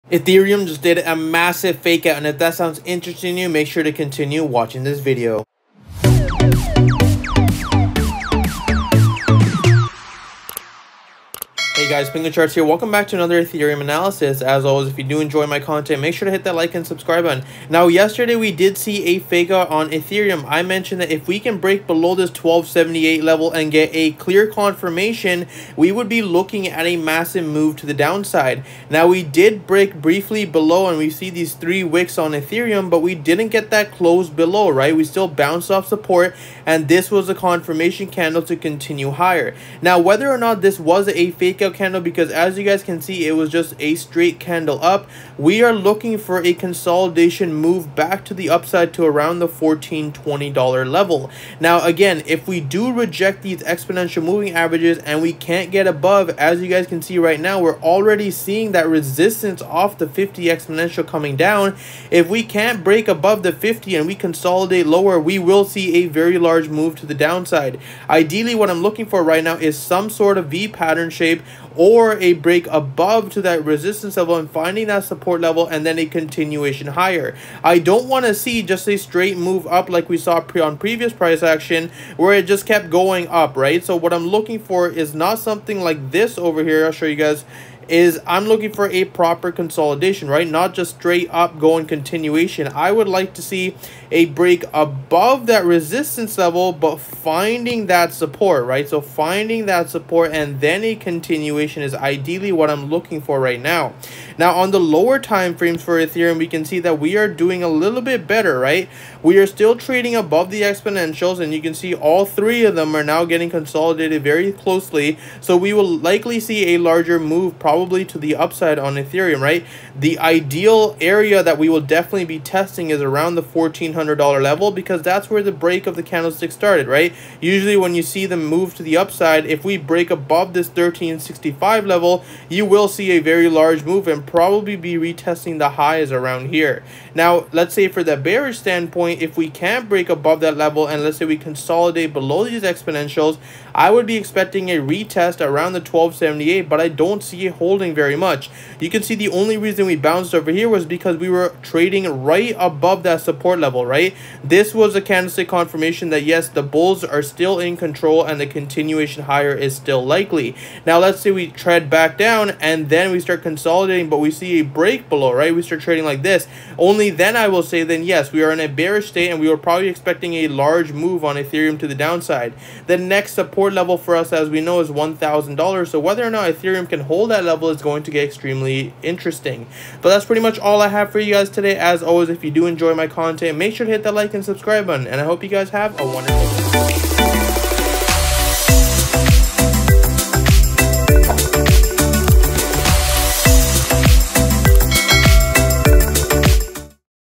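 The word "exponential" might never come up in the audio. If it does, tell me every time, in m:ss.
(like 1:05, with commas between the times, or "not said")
0:53, 1:00, 1:50, 2:22.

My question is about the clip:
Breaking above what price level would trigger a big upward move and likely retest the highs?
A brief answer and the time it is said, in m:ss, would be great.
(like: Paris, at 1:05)
1365, at 2:10.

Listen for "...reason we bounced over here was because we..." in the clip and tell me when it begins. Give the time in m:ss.
2:29.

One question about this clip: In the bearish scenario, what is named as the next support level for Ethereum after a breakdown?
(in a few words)
$1,000.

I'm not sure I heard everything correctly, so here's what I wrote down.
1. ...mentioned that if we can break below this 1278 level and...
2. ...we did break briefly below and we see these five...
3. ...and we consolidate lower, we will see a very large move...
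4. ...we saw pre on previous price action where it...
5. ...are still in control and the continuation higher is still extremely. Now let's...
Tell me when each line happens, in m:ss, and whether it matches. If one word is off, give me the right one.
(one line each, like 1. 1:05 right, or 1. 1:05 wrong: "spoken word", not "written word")
1. 0:20 right
2. 0:29 wrong: "three", not "five"
3. 1:03 right
4. 1:20 right
5. 2:37 wrong: "likely", not "extremely".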